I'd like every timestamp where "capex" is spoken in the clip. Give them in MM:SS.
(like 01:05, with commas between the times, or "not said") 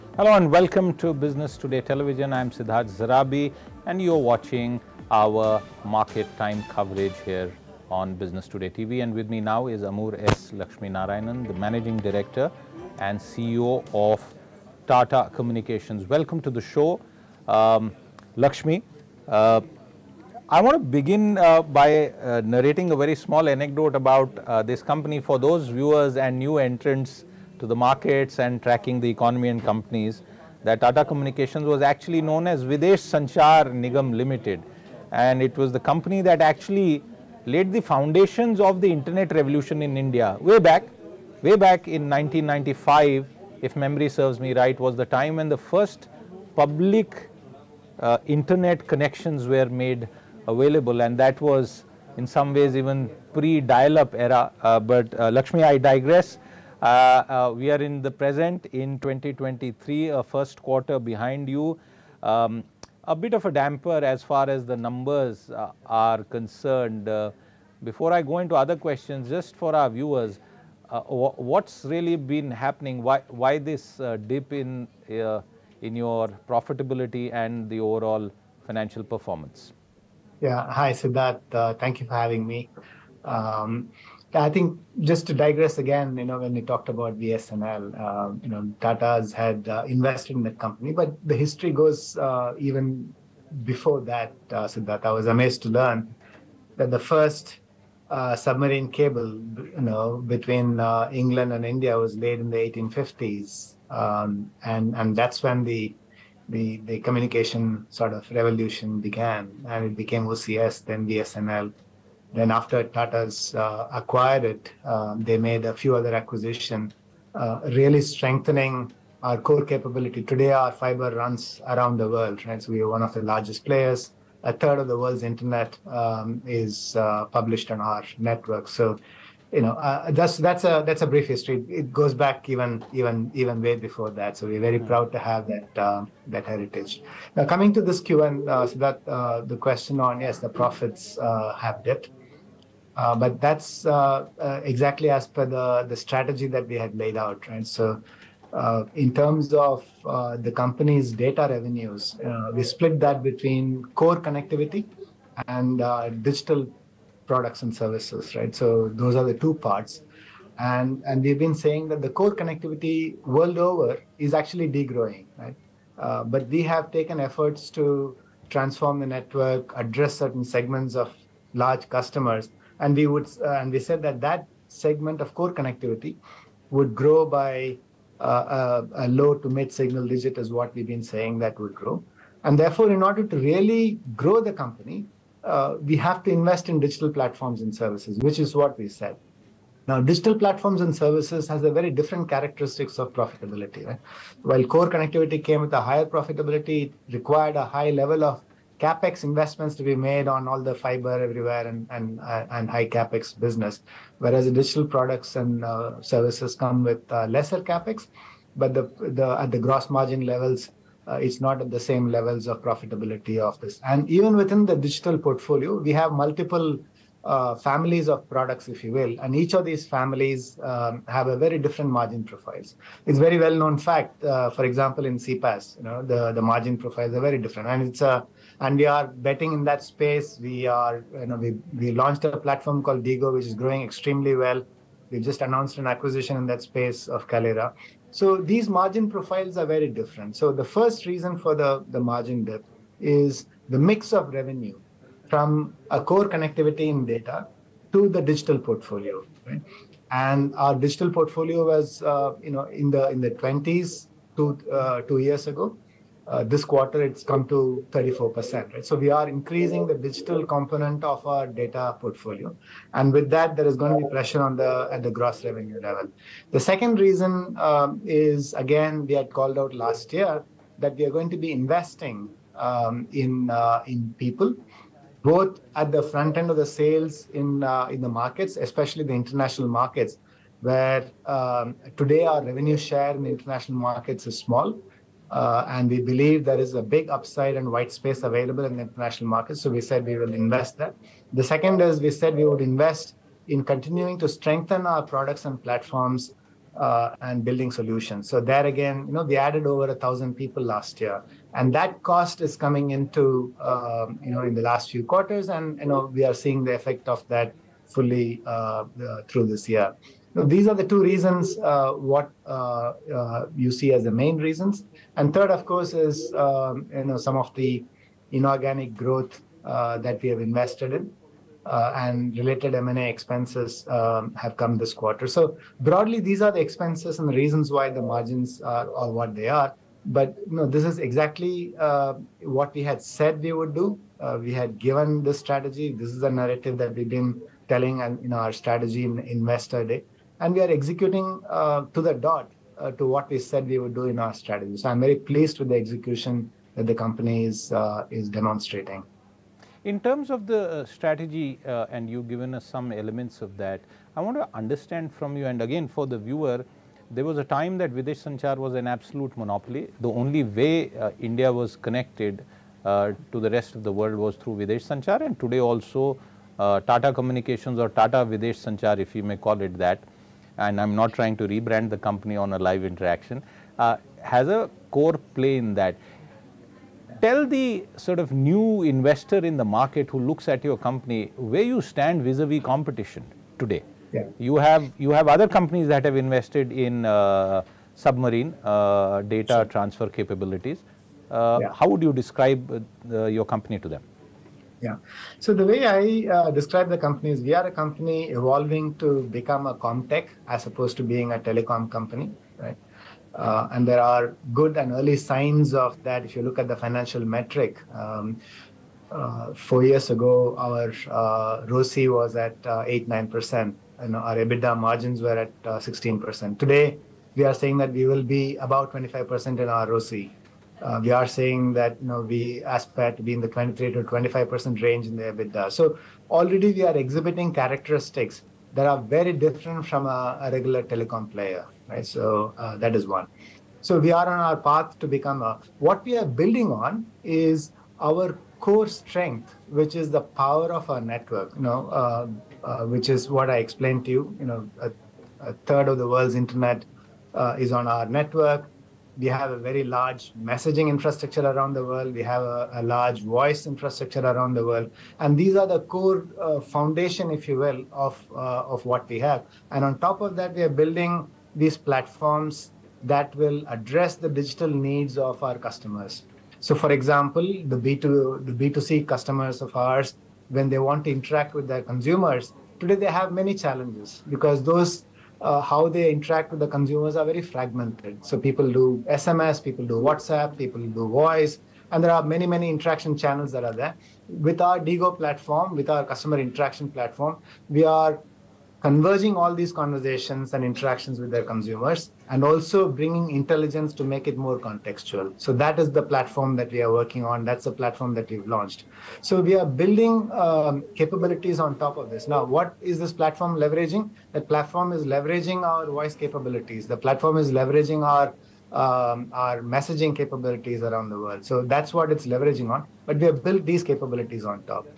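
03:18, 03:22, 03:27.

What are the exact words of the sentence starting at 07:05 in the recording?
So already we are exhibiting characteristics that are very different from a, a regular telecom player, right?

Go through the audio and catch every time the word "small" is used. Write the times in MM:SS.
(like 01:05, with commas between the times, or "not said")
00:23, 04:44.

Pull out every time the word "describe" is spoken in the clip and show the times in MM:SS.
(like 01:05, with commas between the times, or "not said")
06:32, 06:36.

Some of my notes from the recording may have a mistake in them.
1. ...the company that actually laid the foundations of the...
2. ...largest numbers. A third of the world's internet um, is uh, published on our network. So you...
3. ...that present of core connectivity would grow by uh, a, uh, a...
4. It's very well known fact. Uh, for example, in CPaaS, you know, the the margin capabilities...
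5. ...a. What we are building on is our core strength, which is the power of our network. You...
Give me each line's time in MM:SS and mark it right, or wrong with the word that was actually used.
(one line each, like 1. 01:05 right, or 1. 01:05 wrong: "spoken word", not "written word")
1. 00:35 right
2. 02:03 wrong: "players", not "numbers"
3. 02:54 wrong: "segment", not "present"
4. 03:43 wrong: "profiles", not "capabilities"
5. 07:15 right.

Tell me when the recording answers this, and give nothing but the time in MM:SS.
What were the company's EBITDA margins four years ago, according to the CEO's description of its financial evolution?
06:55.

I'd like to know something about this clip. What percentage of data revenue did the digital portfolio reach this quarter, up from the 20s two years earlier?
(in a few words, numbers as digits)
34%.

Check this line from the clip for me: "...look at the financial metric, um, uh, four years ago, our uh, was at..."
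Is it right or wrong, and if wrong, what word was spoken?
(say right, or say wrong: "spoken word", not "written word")
right.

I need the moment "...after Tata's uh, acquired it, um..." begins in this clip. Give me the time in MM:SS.
01:52.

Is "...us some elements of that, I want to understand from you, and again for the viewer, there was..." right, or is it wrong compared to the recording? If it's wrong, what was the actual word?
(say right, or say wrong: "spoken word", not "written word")
right.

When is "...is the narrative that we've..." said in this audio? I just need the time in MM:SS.
05:36.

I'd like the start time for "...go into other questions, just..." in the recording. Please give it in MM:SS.
01:08.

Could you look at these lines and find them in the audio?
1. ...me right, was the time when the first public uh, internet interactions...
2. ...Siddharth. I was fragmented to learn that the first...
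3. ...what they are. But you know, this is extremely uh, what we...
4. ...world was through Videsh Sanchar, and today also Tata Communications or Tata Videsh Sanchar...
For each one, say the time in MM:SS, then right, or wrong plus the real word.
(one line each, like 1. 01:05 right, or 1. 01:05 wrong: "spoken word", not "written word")
1. 00:44 wrong: "connections", not "interactions"
2. 01:34 wrong: "amazed", not "fragmented"
3. 05:29 wrong: "exactly", not "extremely"
4. 06:03 right.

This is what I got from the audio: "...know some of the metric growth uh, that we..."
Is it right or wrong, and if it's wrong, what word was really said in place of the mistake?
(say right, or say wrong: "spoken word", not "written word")
wrong: "inorganic", not "metric".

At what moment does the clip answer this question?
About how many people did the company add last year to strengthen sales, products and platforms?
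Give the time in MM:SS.
04:59.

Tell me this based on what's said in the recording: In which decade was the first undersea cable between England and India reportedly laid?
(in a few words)
1850s.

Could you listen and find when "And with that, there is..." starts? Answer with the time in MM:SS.
04:22.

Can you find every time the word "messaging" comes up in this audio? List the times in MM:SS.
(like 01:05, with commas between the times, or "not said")
07:30, 08:29.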